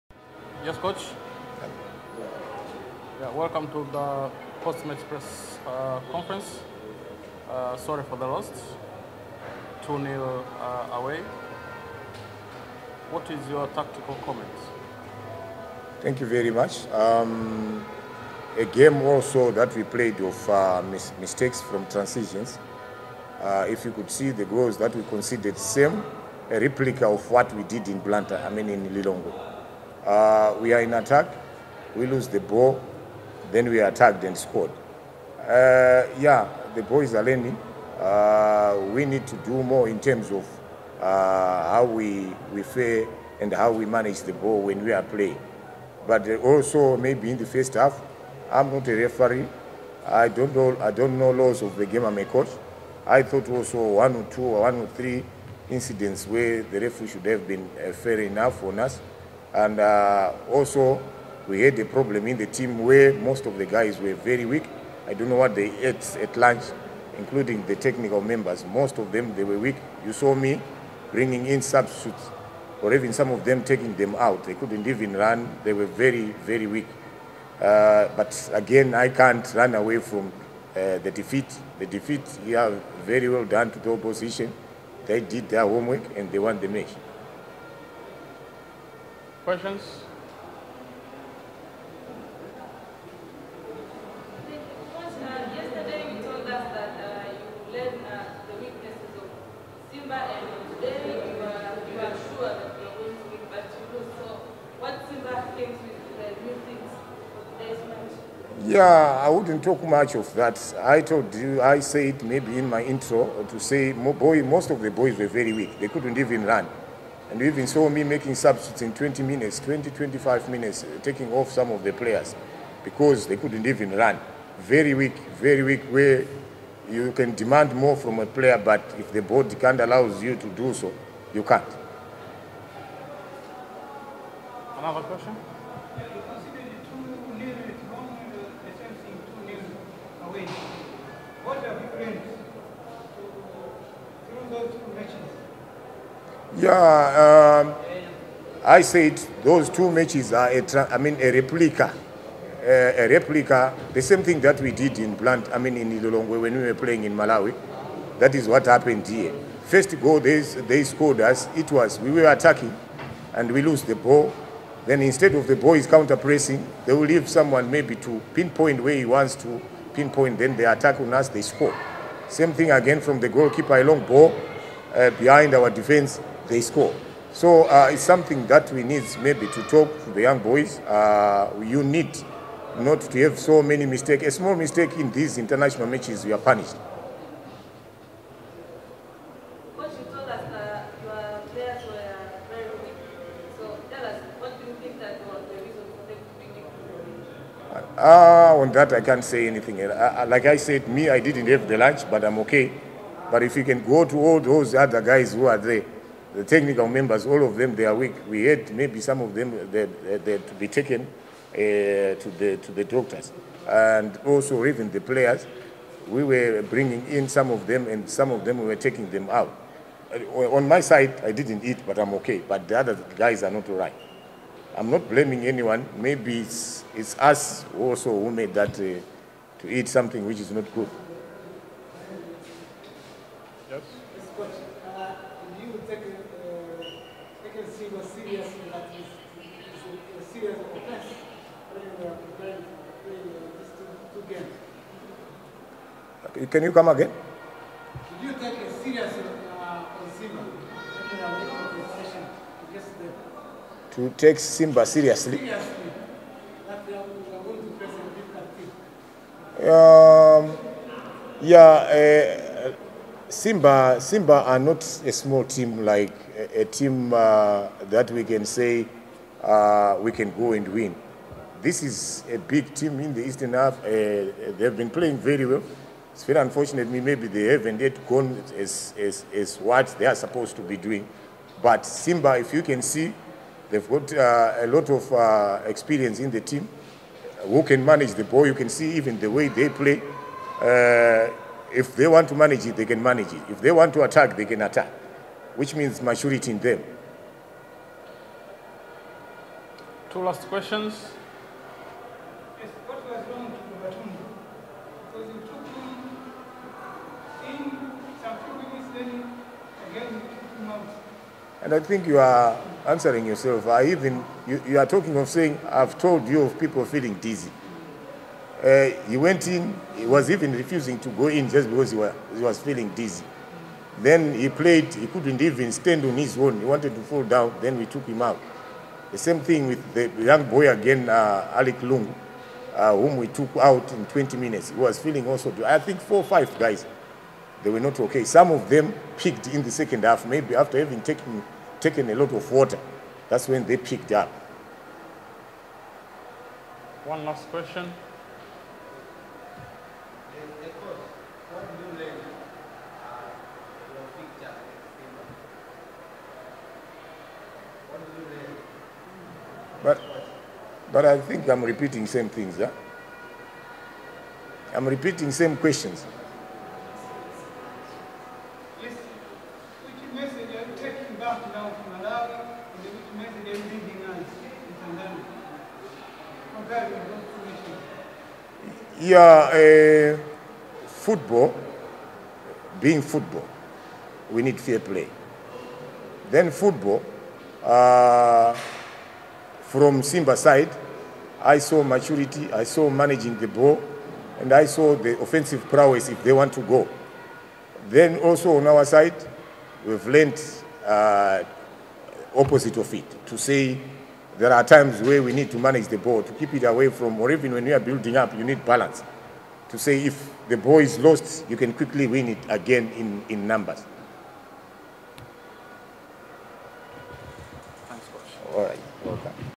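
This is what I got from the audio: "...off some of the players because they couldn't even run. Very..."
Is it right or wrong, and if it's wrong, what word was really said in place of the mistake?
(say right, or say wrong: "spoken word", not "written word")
right.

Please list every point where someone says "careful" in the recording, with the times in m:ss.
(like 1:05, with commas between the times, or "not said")
not said.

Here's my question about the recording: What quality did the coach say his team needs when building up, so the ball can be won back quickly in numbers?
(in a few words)
Balance.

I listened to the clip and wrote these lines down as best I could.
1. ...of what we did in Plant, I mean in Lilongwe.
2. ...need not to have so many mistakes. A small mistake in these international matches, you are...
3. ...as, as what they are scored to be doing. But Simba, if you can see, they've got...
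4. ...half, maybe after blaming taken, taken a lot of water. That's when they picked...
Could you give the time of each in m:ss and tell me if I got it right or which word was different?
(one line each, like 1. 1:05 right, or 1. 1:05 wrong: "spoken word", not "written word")
1. 0:27 wrong: "Blantyre", not "Plant"
2. 3:01 right
3. 4:38 wrong: "supposed", not "scored"
4. 5:40 wrong: "having", not "blaming".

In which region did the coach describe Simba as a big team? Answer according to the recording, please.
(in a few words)
Eastern half.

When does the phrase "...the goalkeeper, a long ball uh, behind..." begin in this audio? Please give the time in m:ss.
2:53.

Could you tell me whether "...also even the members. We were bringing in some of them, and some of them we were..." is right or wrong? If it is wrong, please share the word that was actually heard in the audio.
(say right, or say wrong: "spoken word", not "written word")
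wrong: "players", not "members".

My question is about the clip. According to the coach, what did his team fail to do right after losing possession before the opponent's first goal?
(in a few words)
Counter-pressing.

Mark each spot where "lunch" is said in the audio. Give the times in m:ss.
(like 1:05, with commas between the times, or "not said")
1:06, 3:21.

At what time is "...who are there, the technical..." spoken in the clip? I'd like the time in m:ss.
3:25.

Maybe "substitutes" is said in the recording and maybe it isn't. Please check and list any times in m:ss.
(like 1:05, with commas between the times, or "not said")
1:11, 1:58.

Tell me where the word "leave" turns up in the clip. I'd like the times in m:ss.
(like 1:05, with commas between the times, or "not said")
2:47.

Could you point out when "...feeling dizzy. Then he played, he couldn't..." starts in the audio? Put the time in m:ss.
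5:22.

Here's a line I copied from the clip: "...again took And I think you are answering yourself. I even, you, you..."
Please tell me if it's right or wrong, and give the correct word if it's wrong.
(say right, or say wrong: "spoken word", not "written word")
right.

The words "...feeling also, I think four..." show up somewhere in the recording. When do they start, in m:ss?
5:34.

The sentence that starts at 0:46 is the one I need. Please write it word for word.
But also maybe in the first half, I'm not a referee.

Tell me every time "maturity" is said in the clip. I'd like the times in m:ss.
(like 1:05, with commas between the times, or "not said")
4:56, 6:31.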